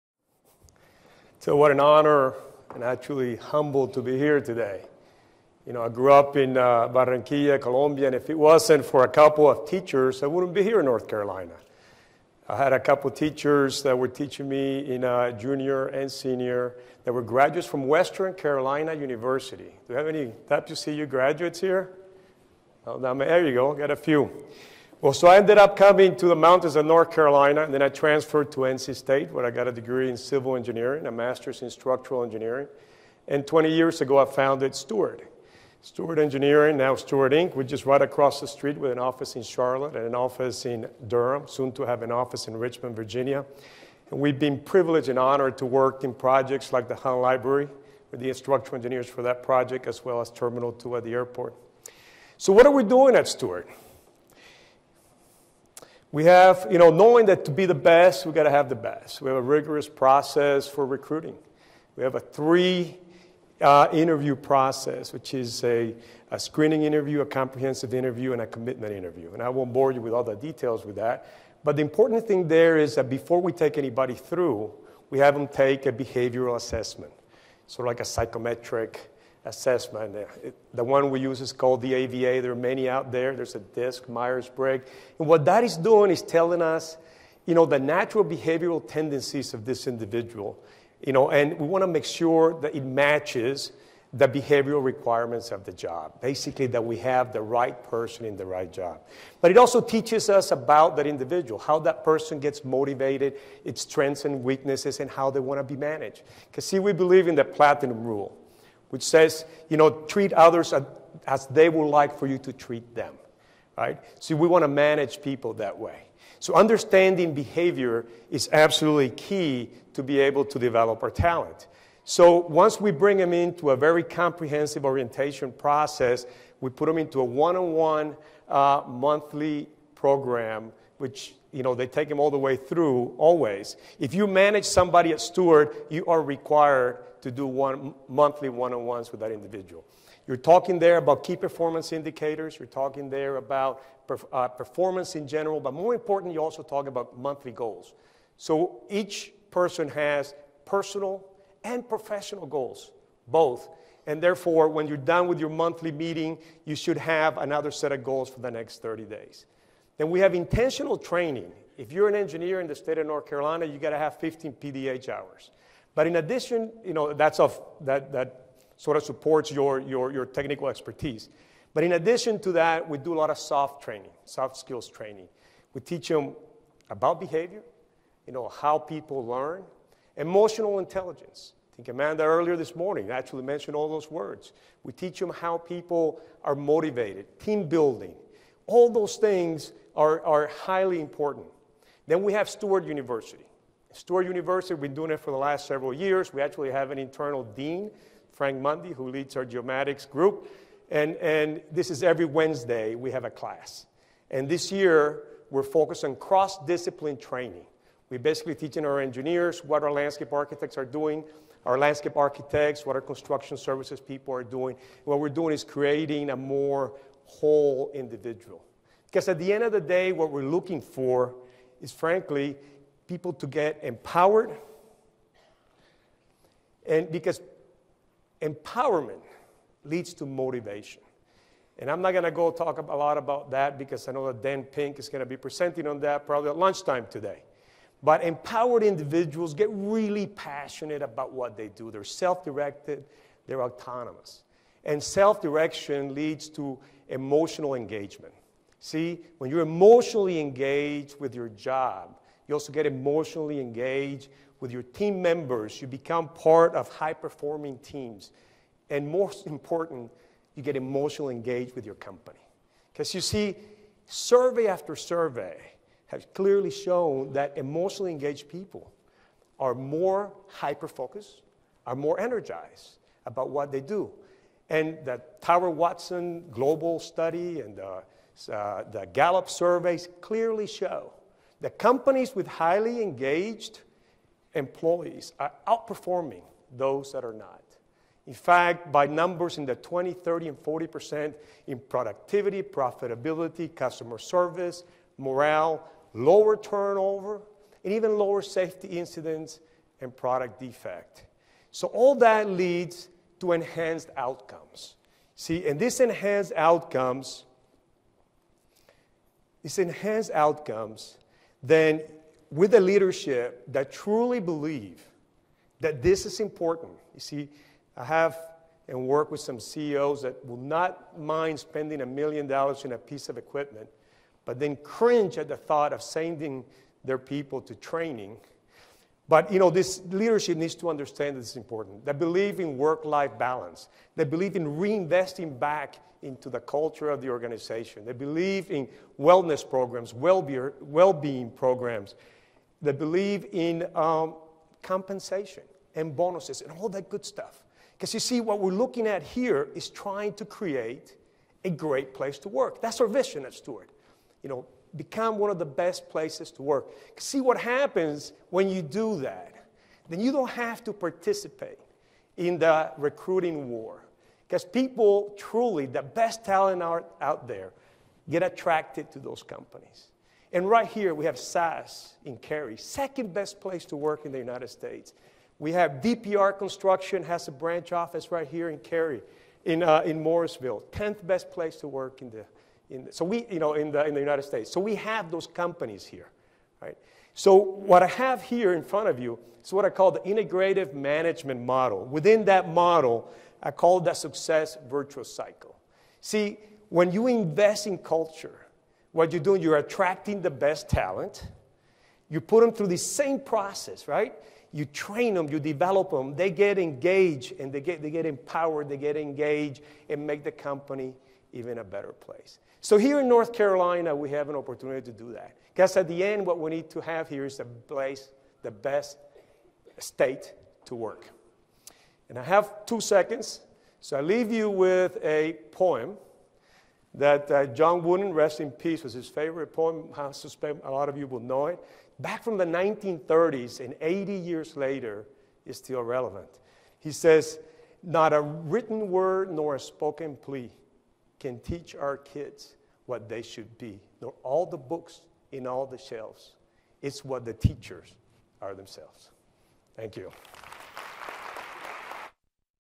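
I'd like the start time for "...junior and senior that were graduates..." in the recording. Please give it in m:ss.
0:15.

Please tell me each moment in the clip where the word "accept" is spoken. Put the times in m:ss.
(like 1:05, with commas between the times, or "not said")
not said.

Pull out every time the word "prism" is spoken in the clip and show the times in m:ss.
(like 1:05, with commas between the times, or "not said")
not said.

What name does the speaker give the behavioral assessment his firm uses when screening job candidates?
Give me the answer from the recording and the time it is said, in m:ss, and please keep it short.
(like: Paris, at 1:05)
AVA, at 1:21.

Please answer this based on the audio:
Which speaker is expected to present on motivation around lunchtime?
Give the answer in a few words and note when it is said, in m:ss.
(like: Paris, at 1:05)
Dan Pink, at 3:54.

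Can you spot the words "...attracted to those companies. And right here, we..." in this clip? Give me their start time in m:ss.
6:08.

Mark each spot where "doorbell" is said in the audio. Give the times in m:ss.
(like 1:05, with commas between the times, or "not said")
not said.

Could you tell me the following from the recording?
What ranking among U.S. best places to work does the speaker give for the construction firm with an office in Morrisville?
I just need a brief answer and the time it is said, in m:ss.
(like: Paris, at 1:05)
10th, at 6:20.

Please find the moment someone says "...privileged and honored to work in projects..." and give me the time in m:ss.
0:44.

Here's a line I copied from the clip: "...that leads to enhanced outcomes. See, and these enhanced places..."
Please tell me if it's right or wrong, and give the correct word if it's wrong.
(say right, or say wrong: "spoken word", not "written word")
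wrong: "outcomes", not "places".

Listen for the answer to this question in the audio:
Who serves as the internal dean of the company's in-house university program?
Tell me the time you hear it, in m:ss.
3:18.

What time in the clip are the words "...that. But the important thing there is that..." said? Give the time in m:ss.
1:10.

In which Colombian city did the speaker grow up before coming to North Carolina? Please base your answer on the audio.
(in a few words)
Barranquilla.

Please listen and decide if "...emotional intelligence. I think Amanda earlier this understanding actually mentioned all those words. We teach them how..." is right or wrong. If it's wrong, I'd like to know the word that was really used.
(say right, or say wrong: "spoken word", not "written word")
wrong: "morning", not "understanding".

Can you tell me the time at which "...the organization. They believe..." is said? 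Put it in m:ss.
5:37.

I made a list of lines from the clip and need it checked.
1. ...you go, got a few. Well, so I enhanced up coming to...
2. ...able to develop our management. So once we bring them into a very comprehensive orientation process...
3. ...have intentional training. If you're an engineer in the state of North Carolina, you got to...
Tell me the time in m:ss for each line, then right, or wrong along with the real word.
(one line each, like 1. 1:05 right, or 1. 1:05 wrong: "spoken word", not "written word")
1. 0:23 wrong: "ended", not "enhanced"
2. 2:00 wrong: "talent", not "management"
3. 2:40 right.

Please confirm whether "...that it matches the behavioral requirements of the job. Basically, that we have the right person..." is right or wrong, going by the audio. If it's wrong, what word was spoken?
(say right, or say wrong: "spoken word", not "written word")
right.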